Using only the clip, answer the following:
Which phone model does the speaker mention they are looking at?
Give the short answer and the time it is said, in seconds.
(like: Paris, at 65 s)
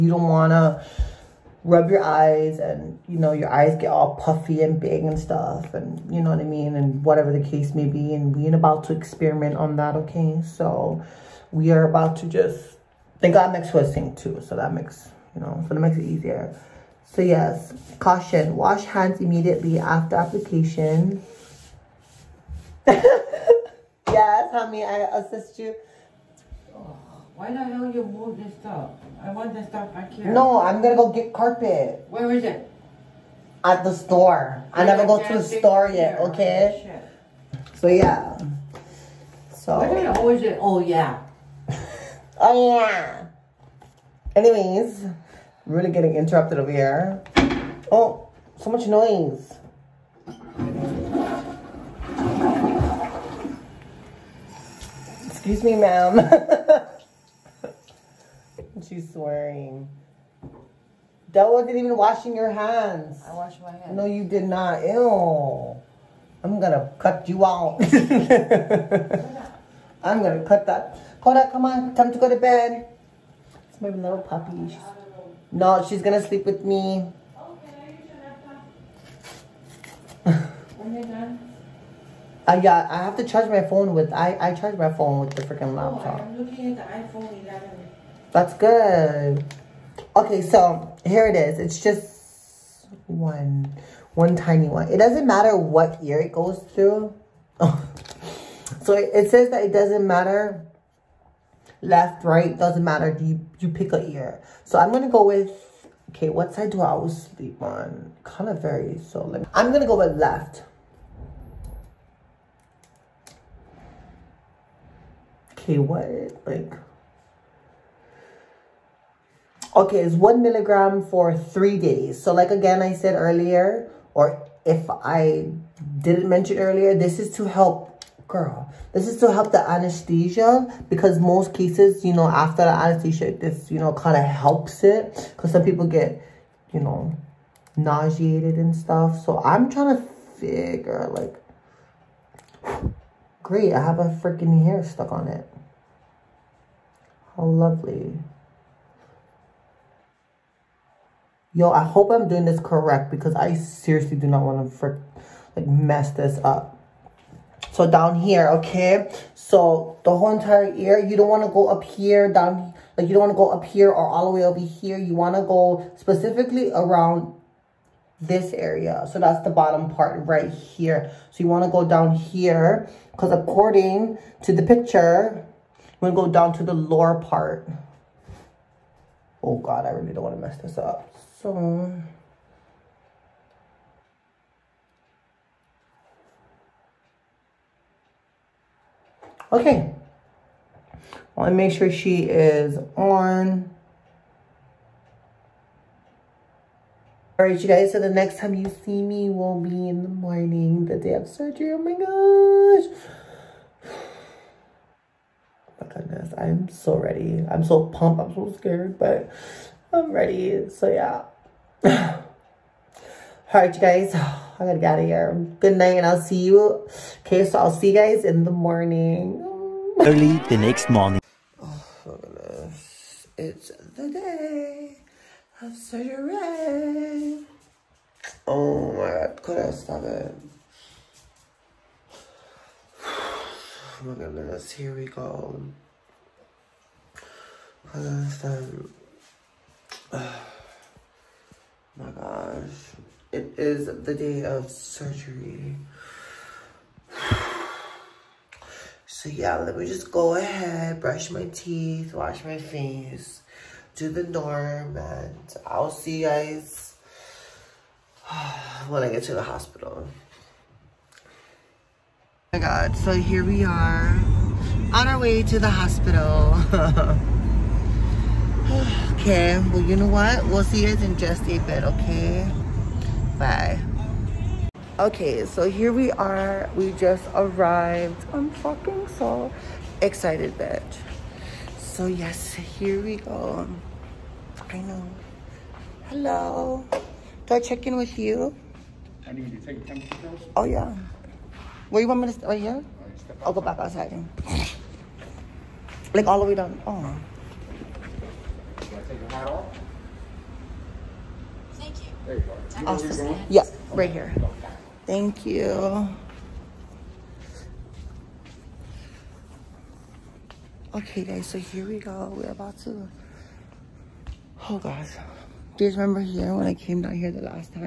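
iPhone 11, at 87 s.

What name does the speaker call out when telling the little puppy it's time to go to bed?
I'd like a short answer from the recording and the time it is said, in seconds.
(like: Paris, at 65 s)
Koda, at 71 s.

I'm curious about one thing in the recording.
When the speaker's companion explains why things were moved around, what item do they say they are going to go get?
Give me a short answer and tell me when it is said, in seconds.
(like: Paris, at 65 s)
carpet, at 31 s.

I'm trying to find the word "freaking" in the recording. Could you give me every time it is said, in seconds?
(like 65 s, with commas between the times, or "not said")
85 s, 144 s.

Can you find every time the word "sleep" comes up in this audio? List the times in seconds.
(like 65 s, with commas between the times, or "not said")
76 s, 107 s.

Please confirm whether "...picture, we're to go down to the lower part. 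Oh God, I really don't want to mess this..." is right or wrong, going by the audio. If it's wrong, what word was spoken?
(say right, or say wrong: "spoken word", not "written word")
right.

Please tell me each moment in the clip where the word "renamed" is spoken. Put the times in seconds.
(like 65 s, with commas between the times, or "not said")
not said.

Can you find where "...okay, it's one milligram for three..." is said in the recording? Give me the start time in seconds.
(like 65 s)
119 s.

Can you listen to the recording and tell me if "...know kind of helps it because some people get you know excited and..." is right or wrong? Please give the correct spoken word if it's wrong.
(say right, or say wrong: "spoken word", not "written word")
wrong: "nauseated", not "excited".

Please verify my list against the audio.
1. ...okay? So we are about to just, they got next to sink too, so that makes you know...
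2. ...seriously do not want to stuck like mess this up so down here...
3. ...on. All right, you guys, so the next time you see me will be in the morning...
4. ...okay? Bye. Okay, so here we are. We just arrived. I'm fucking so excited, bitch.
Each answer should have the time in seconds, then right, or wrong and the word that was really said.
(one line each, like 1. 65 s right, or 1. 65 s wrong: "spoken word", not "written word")
1. 9 s right
2. 153 s wrong: "frick", not "stuck"
3. 192 s right
4. 271 s right.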